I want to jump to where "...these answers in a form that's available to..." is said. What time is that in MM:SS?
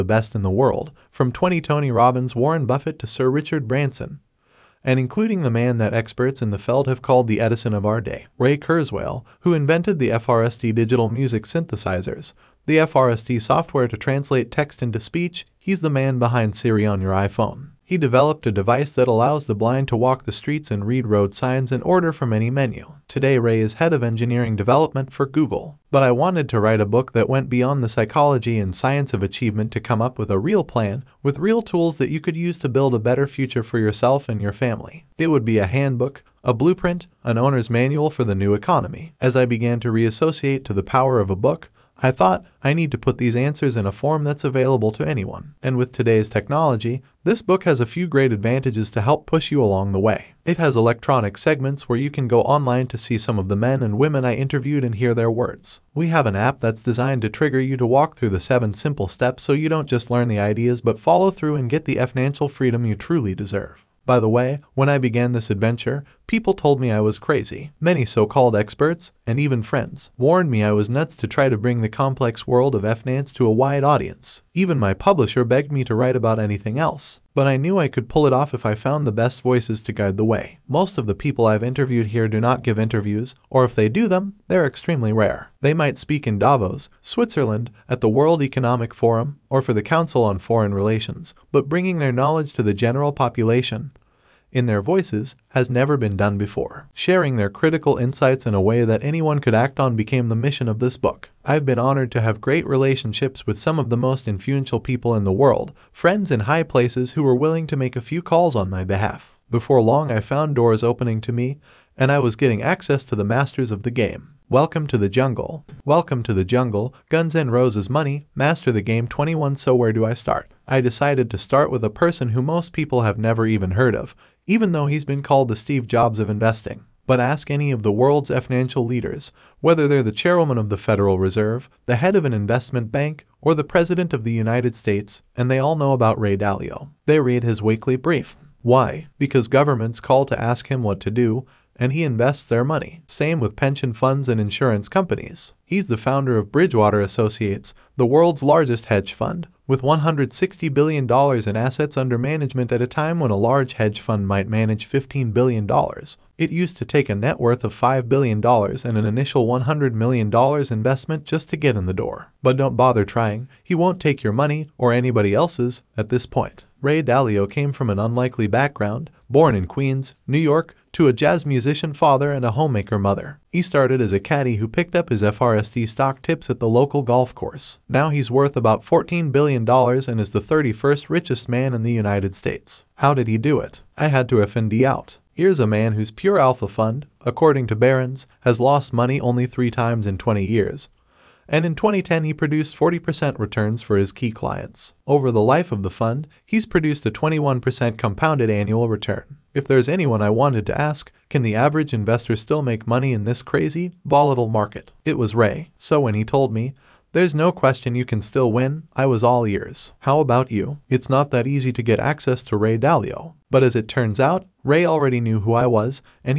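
00:43.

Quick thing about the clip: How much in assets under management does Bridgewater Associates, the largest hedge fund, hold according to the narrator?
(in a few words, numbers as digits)
$160 billion.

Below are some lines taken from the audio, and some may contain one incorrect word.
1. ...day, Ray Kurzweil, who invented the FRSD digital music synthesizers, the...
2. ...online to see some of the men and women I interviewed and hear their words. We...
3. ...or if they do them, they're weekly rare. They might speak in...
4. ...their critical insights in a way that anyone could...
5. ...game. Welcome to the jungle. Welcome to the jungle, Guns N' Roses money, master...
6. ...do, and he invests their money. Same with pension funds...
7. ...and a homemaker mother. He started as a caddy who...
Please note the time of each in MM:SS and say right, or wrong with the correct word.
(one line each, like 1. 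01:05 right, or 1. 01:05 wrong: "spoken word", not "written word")
1. 00:08 right
2. 00:52 right
3. 01:23 wrong: "extremely", not "weekly"
4. 01:37 right
5. 01:53 right
6. 02:21 right
7. 02:52 right.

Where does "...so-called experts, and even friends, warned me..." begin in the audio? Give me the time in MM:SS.
01:08.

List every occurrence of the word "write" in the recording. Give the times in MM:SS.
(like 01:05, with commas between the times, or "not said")
00:26, 01:15.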